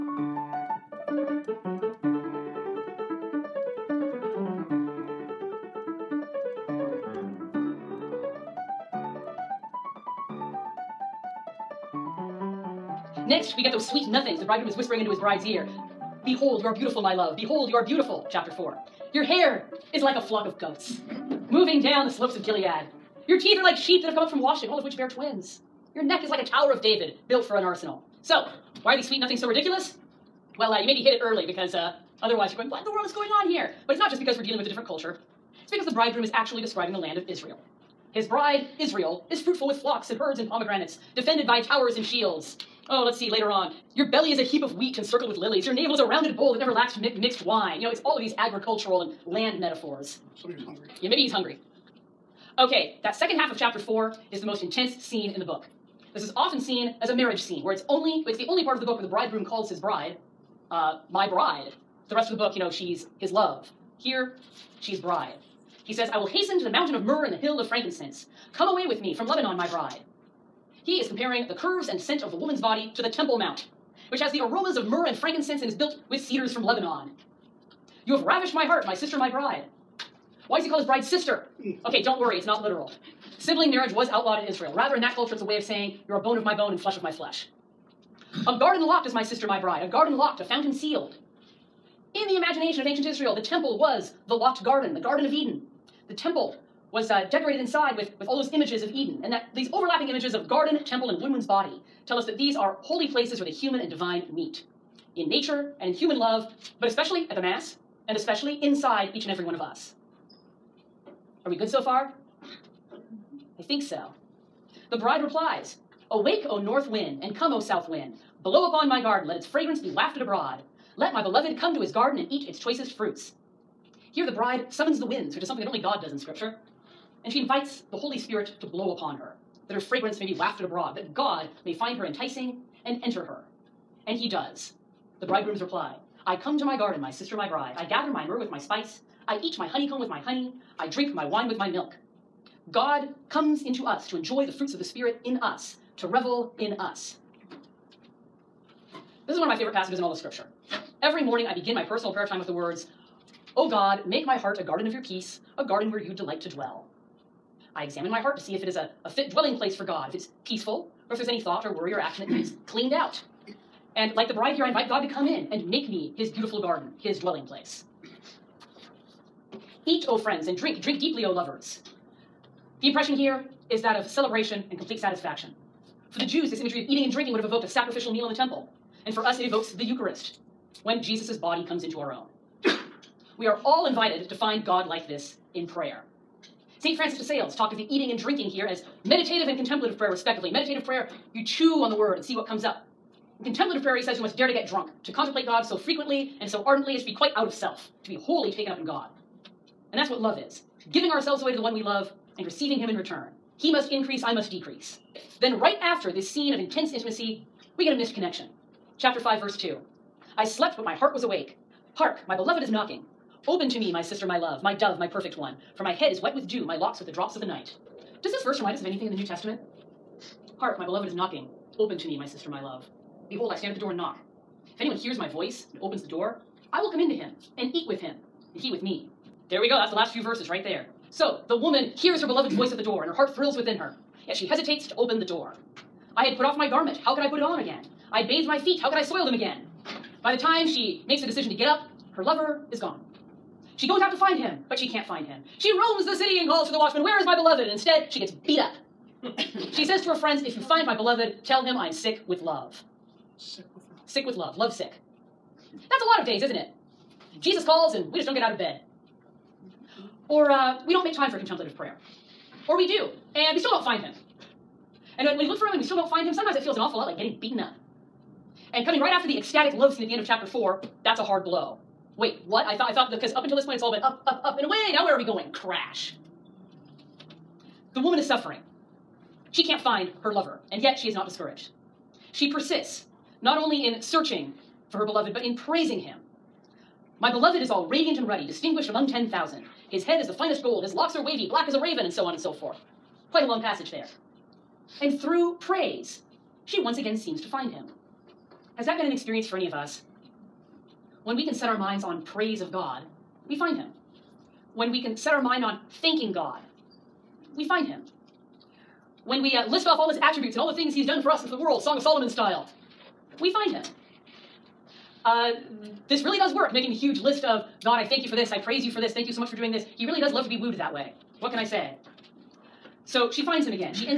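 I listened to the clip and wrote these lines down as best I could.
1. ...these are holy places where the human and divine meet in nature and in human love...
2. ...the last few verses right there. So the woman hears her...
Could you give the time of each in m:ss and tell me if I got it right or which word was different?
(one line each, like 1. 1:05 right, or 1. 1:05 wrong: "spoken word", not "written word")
1. 1:42 right
2. 3:49 right.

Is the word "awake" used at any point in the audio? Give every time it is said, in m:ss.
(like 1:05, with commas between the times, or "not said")
1:56, 3:31.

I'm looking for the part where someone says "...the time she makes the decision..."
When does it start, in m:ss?
4:00.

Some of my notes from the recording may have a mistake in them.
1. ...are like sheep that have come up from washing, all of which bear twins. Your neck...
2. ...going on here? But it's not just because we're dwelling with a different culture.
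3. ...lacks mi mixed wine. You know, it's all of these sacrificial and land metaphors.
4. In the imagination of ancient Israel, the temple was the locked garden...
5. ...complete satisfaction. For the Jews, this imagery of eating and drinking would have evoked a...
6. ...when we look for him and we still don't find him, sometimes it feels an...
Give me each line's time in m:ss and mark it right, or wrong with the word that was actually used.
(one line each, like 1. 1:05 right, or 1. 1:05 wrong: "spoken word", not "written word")
1. 0:23 right
2. 0:33 wrong: "dealing", not "dwelling"
3. 0:46 wrong: "agricultural", not "sacrificial"
4. 1:32 right
5. 2:54 right
6. 4:25 right.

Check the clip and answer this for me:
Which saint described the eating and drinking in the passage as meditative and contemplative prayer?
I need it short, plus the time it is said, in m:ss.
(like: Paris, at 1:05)
St. 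Francis de Sales, at 3:06.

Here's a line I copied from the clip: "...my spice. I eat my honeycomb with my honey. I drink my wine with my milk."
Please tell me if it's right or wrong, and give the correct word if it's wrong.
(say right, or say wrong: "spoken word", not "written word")
right.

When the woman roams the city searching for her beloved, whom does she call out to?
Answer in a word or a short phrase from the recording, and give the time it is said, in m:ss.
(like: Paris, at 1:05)
the watchman, at 4:06.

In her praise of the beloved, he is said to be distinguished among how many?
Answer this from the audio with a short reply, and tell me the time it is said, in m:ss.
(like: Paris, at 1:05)
10,000, at 4:49.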